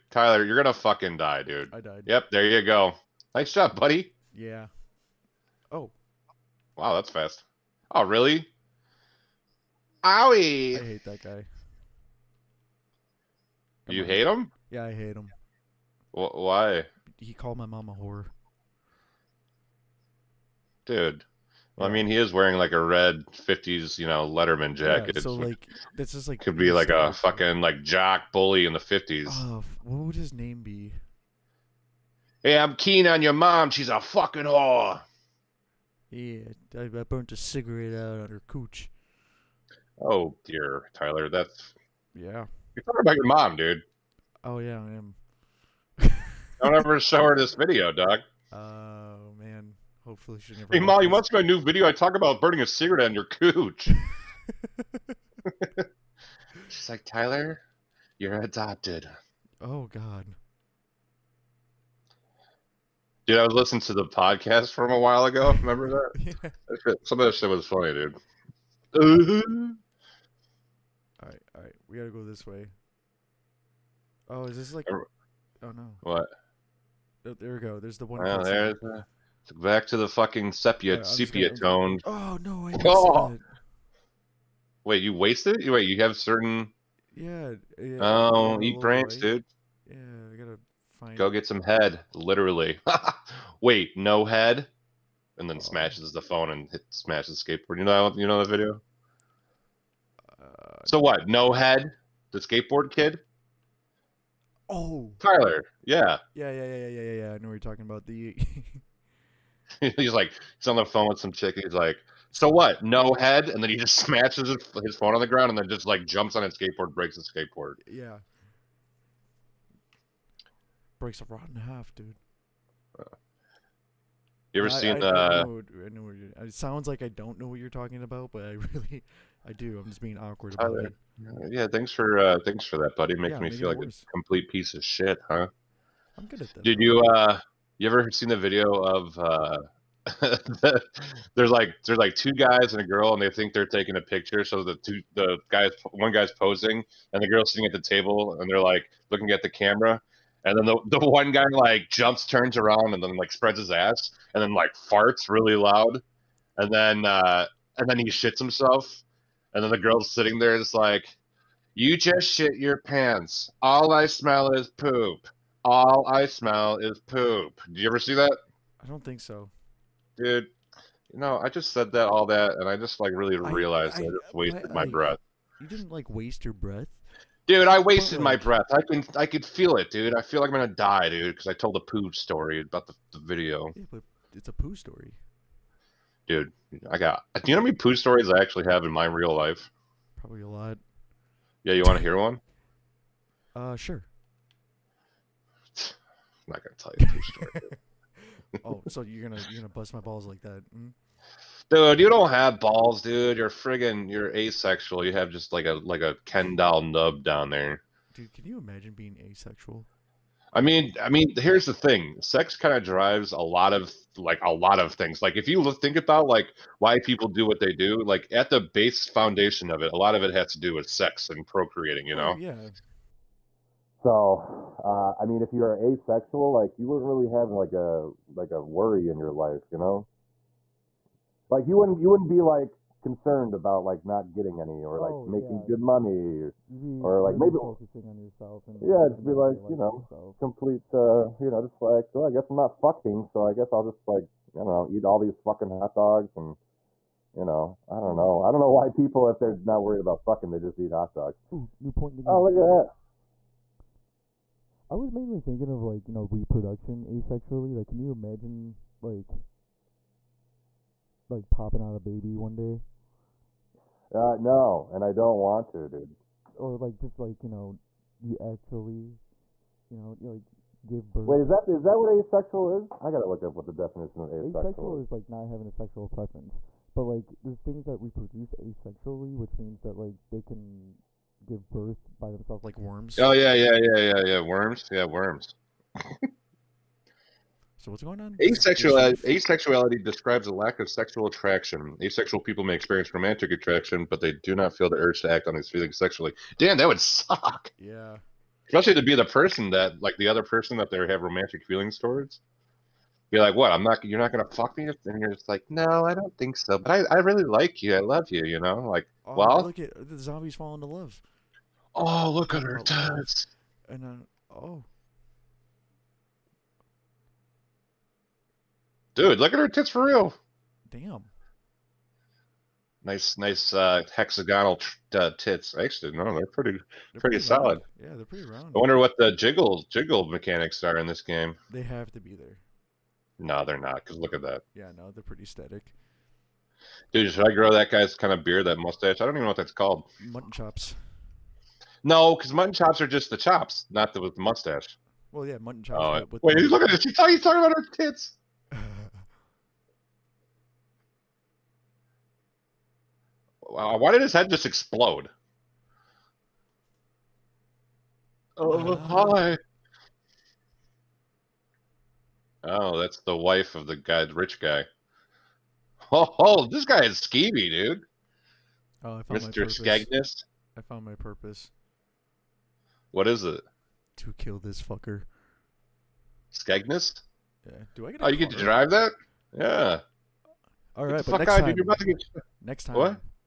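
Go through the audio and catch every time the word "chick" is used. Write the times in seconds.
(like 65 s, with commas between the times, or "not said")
111 s.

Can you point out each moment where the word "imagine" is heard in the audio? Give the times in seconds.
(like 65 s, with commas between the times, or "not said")
208 s, 258 s.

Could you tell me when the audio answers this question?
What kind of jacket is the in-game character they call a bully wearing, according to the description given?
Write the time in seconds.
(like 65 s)
24 s.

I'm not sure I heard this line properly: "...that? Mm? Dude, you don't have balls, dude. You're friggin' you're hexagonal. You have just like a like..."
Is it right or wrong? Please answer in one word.
wrong.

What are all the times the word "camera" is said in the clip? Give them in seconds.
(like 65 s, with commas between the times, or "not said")
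149 s.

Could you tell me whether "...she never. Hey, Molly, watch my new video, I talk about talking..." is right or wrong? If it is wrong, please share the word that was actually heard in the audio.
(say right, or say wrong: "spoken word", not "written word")
wrong: "burning", not "talking".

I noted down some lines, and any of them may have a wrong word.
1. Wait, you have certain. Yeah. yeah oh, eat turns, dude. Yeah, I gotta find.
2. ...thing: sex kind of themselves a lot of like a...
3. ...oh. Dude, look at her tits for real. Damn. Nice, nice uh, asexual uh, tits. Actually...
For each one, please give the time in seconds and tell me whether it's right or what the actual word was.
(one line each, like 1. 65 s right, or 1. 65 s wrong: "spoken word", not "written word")
1. 85 s wrong: "brains", not "turns"
2. 211 s wrong: "drives", not "themselves"
3. 314 s wrong: "hexagonal", not "asexual".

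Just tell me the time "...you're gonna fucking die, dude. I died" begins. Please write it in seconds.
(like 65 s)
0 s.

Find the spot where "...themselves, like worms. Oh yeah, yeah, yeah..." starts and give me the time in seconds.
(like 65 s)
282 s.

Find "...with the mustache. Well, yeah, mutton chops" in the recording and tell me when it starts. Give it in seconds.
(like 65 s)
344 s.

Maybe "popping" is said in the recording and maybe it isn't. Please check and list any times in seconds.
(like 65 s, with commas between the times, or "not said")
261 s.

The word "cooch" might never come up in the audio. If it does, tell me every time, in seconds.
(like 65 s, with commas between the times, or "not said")
38 s, 53 s.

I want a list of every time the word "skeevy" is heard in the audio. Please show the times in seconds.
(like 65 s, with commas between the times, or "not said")
367 s.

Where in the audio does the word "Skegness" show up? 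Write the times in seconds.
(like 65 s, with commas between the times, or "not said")
369 s, 376 s.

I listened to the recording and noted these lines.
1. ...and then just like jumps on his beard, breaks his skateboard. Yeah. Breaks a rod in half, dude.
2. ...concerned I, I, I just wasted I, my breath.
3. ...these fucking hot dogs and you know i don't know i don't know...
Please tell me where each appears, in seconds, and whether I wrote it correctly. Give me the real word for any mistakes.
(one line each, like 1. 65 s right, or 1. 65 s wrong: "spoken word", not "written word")
1. 115 s wrong: "skateboard", not "beard"
2. 173 s wrong: "realized", not "concerned"
3. 245 s right.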